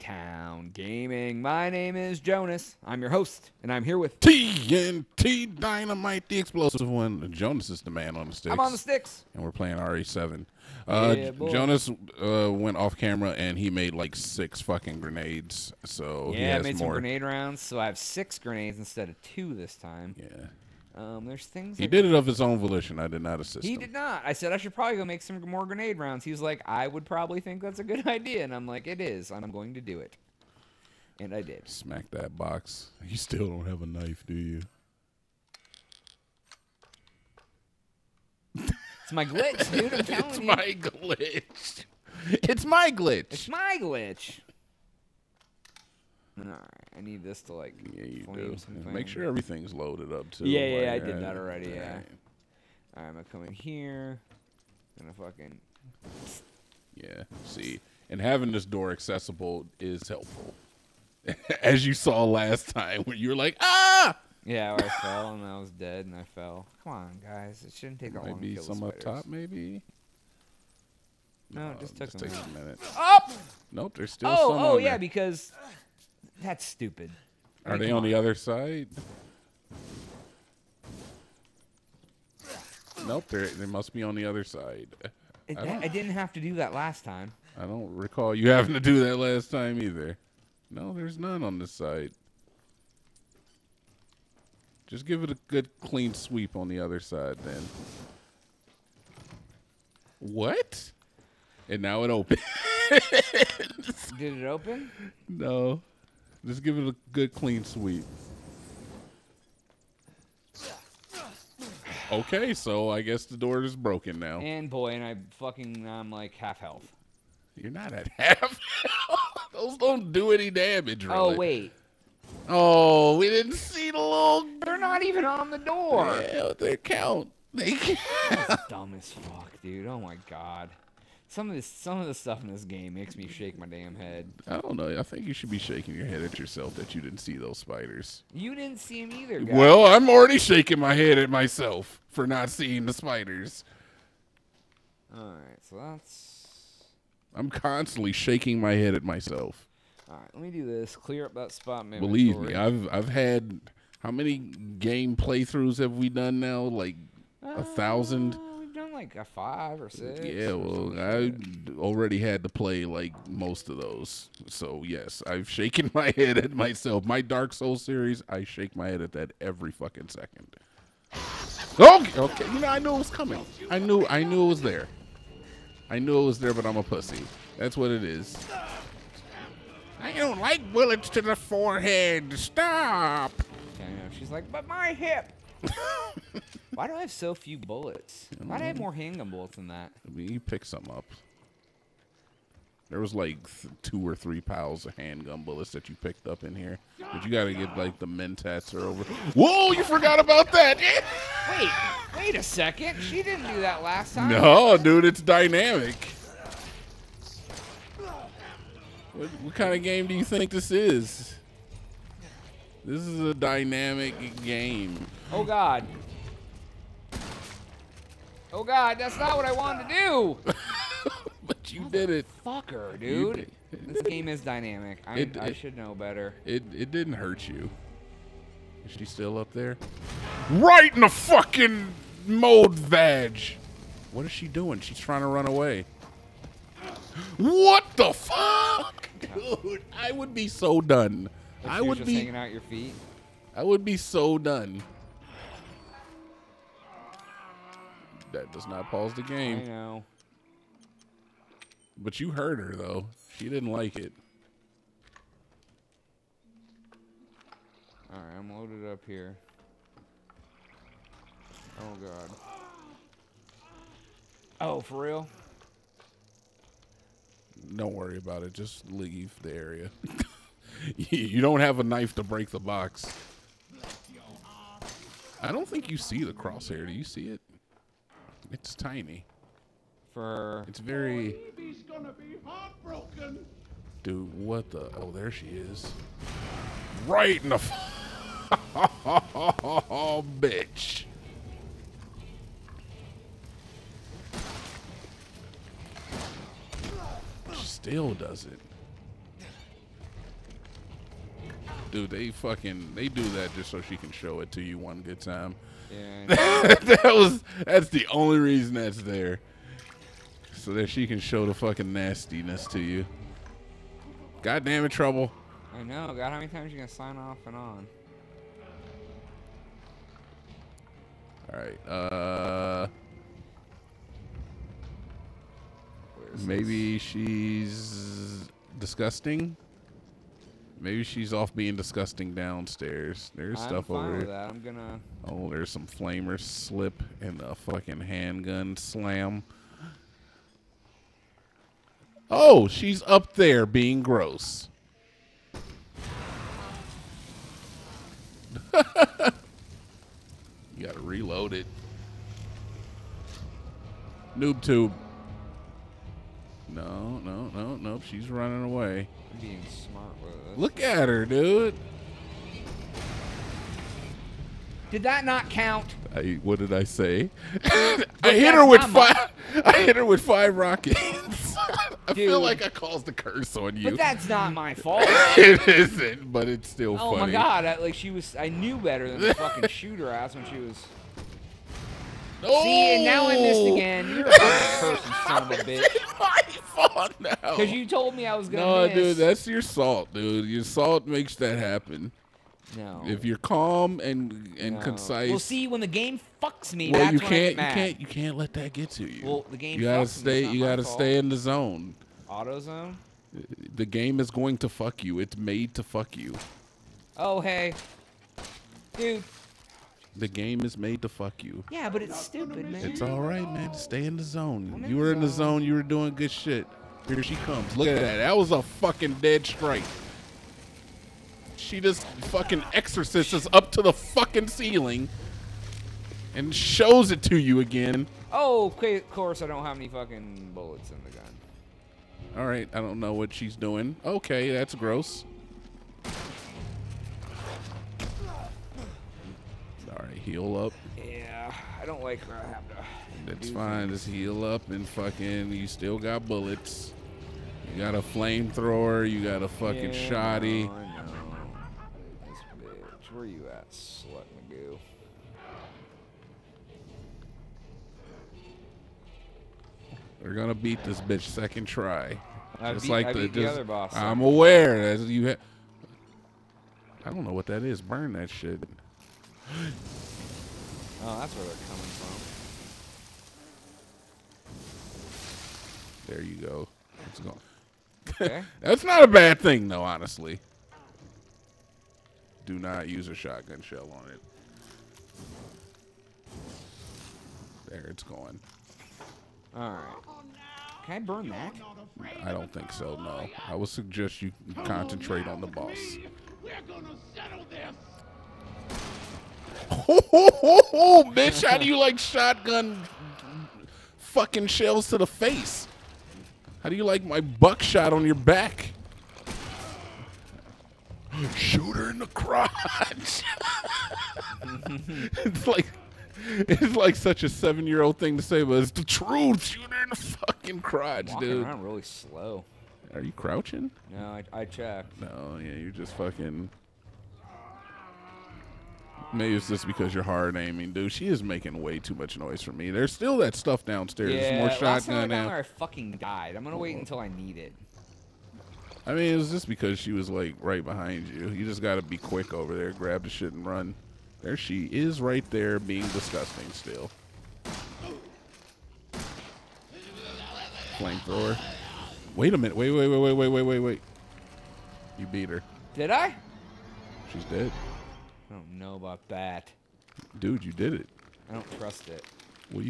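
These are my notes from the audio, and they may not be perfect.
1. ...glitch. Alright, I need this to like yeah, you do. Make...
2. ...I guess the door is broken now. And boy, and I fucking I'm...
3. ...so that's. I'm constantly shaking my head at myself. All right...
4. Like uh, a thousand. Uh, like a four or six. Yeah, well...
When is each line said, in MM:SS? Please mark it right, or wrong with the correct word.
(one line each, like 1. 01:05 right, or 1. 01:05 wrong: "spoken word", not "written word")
1. 00:43 right
2. 01:52 right
3. 02:25 right
4. 02:36 wrong: "five", not "four".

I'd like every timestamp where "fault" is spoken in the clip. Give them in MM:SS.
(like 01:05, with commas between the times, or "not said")
06:14, 06:26, 06:40.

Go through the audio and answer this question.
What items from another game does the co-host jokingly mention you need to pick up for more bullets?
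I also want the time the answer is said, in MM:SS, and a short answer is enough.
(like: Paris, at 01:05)
Mentats, at 03:18.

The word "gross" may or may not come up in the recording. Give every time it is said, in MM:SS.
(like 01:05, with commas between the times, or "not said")
05:44, 07:14.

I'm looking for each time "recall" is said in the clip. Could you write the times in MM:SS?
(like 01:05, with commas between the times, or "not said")
01:27.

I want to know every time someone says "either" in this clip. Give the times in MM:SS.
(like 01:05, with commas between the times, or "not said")
01:29, 02:19.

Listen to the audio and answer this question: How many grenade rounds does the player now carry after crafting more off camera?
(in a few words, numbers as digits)
6.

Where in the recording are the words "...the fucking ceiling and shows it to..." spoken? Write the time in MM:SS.
07:03.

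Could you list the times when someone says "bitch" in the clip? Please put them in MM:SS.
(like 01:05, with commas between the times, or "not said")
04:50, 06:25, 07:32, 07:40, 08:21.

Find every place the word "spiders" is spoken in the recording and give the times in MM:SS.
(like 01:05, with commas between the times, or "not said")
02:17, 02:22.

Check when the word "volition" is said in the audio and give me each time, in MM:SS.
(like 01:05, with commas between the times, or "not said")
00:22.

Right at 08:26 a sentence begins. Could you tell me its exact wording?
How do you like my buckshot on your back?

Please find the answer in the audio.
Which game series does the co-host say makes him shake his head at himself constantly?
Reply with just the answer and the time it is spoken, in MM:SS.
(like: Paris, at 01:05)
Dark Souls, at 02:47.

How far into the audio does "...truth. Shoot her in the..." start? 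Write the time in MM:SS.
08:38.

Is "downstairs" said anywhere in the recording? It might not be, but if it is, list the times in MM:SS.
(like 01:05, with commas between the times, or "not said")
05:32, 08:53.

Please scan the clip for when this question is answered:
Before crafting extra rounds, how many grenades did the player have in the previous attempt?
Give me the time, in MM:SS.
00:19.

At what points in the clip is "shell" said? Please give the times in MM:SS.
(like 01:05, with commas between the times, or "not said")
08:03, 08:24.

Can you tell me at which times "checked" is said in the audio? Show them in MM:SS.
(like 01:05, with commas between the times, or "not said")
08:44.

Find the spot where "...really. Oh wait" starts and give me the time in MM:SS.
02:01.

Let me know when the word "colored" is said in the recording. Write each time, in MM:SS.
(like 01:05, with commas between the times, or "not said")
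not said.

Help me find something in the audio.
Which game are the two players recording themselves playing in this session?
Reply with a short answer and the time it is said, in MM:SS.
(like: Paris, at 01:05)
RE7, at 00:09.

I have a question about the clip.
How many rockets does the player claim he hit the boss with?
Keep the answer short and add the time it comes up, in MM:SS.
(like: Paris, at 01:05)
5, at 06:10.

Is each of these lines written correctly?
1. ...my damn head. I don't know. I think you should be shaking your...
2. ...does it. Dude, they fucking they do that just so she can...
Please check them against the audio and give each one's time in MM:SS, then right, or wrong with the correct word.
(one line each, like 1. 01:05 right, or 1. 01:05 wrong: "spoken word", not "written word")
1. 02:13 right
2. 04:58 right.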